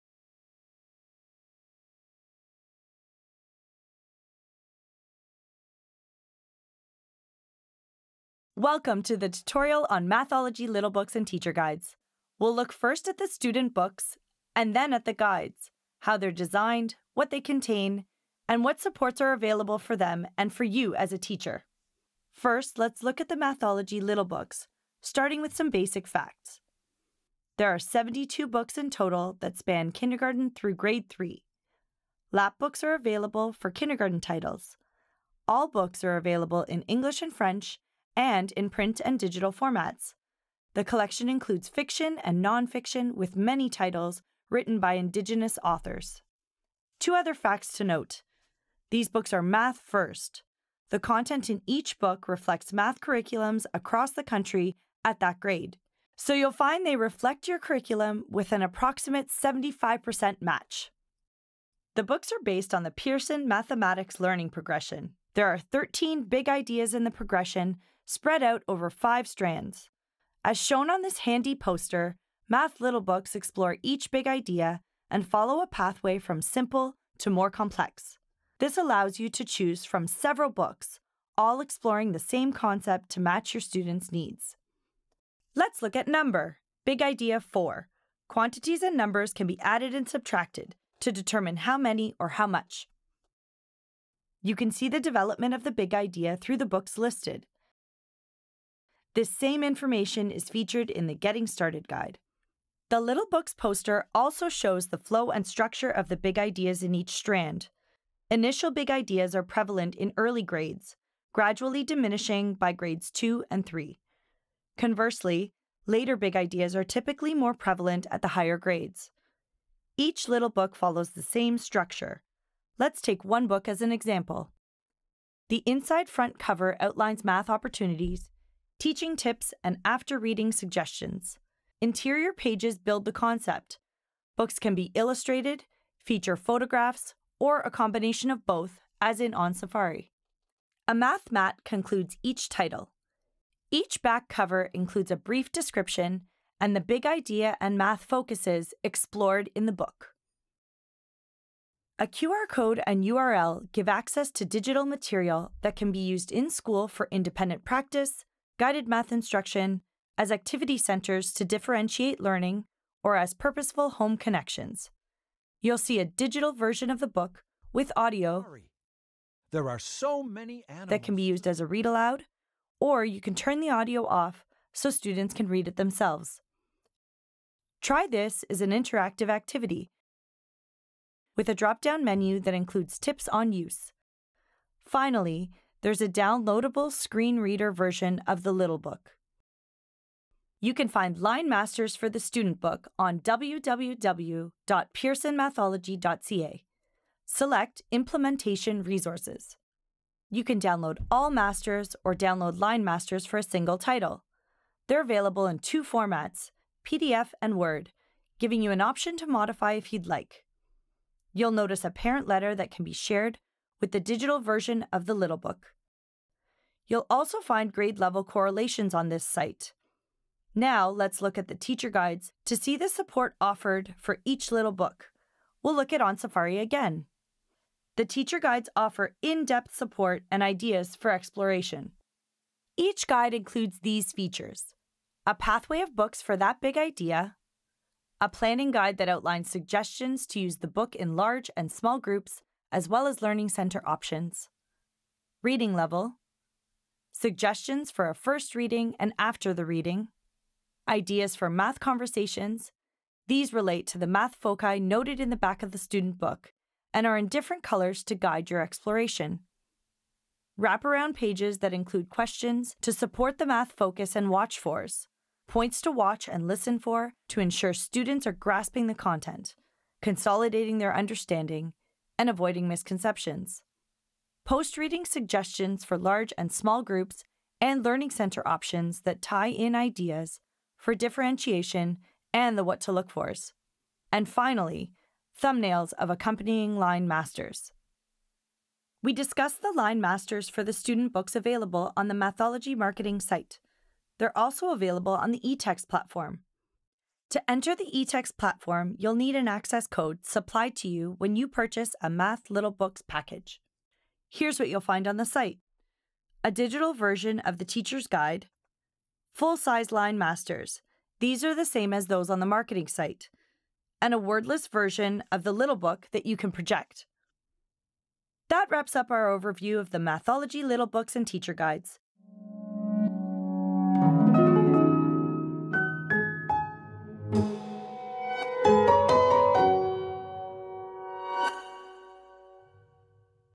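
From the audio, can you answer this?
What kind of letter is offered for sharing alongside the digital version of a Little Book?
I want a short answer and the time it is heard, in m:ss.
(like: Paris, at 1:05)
Parent letter, at 3:31.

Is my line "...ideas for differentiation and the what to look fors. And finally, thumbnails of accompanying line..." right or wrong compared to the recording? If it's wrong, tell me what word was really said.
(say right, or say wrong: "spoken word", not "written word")
right.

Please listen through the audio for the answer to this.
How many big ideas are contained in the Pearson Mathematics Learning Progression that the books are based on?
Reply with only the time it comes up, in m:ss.
1:05.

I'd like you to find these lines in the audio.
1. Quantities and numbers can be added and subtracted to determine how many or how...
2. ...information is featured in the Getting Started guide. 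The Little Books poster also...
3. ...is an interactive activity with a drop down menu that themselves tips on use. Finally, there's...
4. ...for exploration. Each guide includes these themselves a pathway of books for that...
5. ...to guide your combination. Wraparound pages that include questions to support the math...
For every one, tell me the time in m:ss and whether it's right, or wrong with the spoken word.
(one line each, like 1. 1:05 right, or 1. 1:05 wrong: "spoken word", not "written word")
1. 1:28 right
2. 1:39 right
3. 2:58 wrong: "includes", not "themselves"
4. 3:50 wrong: "features", not "themselves"
5. 4:18 wrong: "exploration", not "combination".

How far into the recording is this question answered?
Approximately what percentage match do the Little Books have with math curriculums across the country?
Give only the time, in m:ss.
0:59.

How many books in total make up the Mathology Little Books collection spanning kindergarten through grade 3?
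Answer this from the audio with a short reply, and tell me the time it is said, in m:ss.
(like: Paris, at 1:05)
72, at 0:27.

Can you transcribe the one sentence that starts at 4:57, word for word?
To enter the eText platform, you'll need an access code supplied to you when you purchase a Math Little Books package.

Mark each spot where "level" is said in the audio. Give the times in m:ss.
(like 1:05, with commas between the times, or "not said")
3:37, 4:05.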